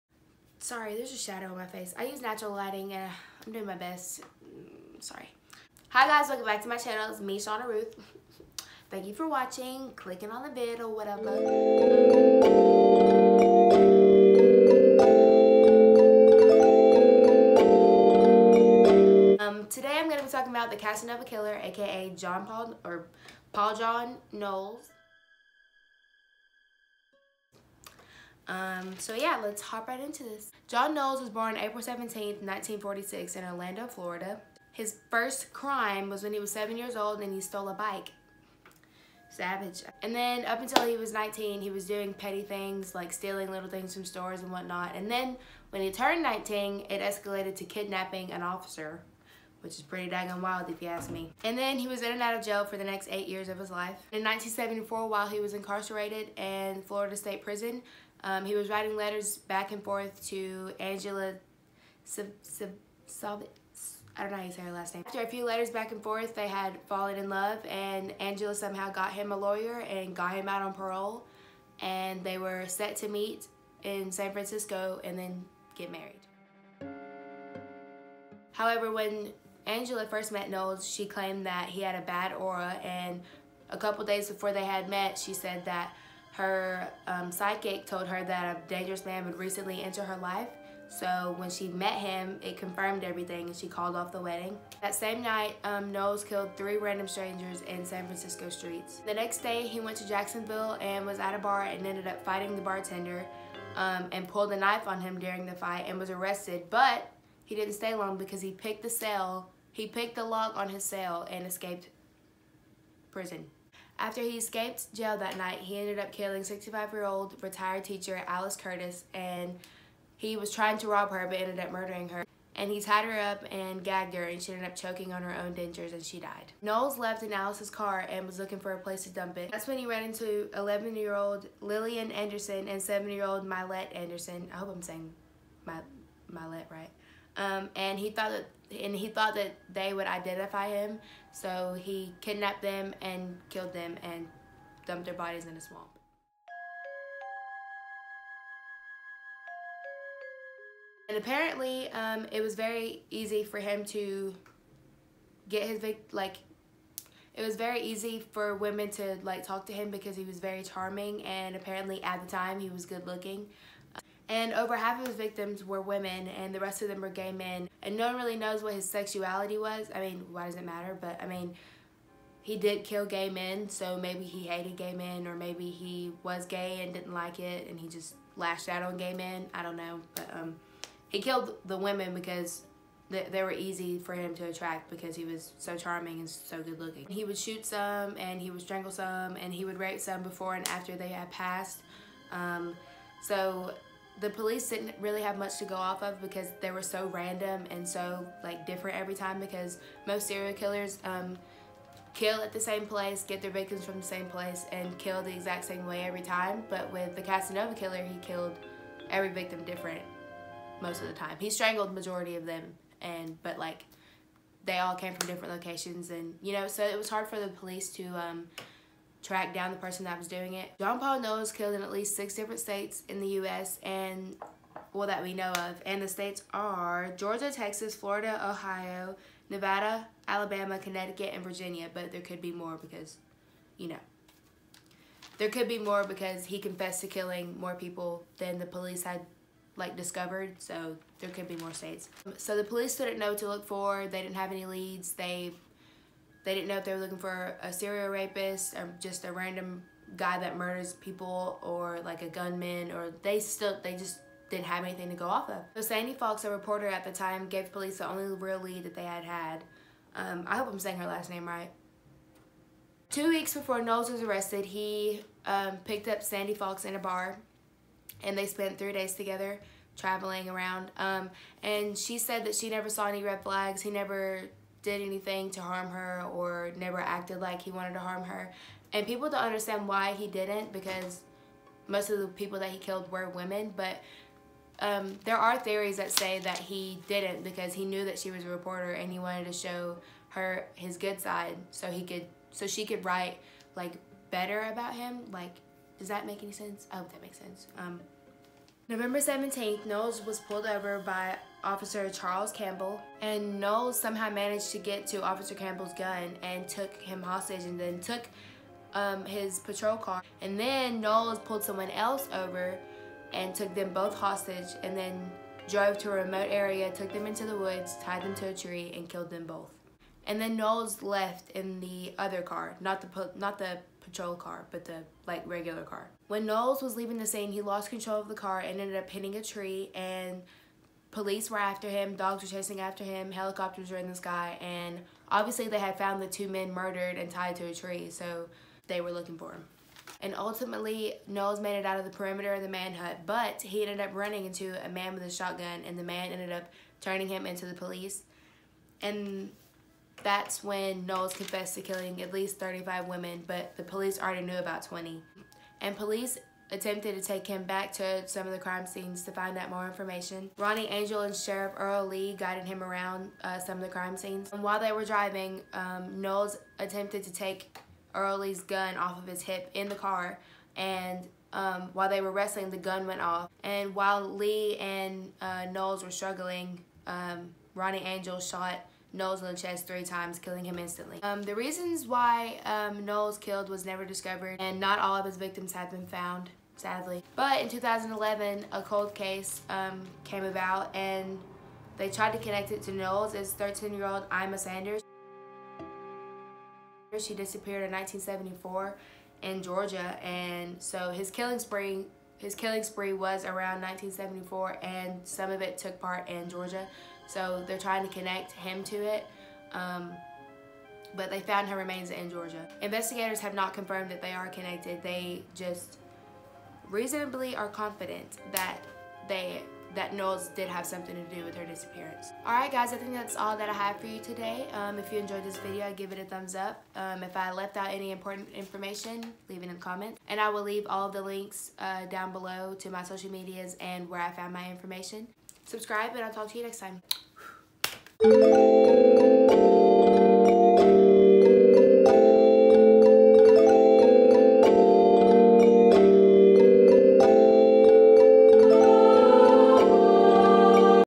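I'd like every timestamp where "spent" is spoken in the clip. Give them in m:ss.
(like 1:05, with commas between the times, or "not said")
4:28.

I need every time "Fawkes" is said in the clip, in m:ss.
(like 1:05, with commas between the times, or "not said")
4:16, 4:26.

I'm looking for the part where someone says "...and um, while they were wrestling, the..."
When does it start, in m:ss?
6:10.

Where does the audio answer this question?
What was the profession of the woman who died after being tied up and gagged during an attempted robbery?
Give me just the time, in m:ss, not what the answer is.
1:57.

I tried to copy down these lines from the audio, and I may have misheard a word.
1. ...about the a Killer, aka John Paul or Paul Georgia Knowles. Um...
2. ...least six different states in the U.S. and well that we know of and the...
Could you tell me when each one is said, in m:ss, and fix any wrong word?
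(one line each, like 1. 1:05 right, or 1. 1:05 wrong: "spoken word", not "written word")
1. 0:20 wrong: "John", not "Georgia"
2. 3:41 right.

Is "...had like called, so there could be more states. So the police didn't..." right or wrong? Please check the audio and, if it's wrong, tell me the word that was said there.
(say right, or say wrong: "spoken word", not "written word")
wrong: "discovered", not "called".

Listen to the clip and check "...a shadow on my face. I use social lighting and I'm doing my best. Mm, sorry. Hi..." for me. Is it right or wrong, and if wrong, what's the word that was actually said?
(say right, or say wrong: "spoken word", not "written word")
wrong: "natural", not "social".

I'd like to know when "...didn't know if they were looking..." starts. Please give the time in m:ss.
4:06.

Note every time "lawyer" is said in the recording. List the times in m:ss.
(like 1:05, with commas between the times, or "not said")
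1:09.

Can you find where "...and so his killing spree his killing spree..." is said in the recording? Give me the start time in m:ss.
6:40.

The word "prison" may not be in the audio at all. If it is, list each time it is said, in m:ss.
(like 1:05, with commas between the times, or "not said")
0:57, 1:53.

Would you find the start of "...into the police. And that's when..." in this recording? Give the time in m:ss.
5:47.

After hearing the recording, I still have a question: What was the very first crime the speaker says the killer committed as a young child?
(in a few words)
Stole a bike.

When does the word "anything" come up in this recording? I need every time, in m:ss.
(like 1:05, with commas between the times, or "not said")
4:14, 4:35.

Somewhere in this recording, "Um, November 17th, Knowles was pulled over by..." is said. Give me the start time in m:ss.
4:57.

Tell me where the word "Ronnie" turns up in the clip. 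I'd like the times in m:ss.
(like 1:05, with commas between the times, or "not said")
6:00, 6:17.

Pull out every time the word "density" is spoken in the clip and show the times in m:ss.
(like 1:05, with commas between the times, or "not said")
not said.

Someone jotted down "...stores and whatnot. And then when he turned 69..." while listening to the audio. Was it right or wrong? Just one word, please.
wrong.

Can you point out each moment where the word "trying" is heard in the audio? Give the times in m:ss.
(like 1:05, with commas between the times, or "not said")
2:00, 6:47.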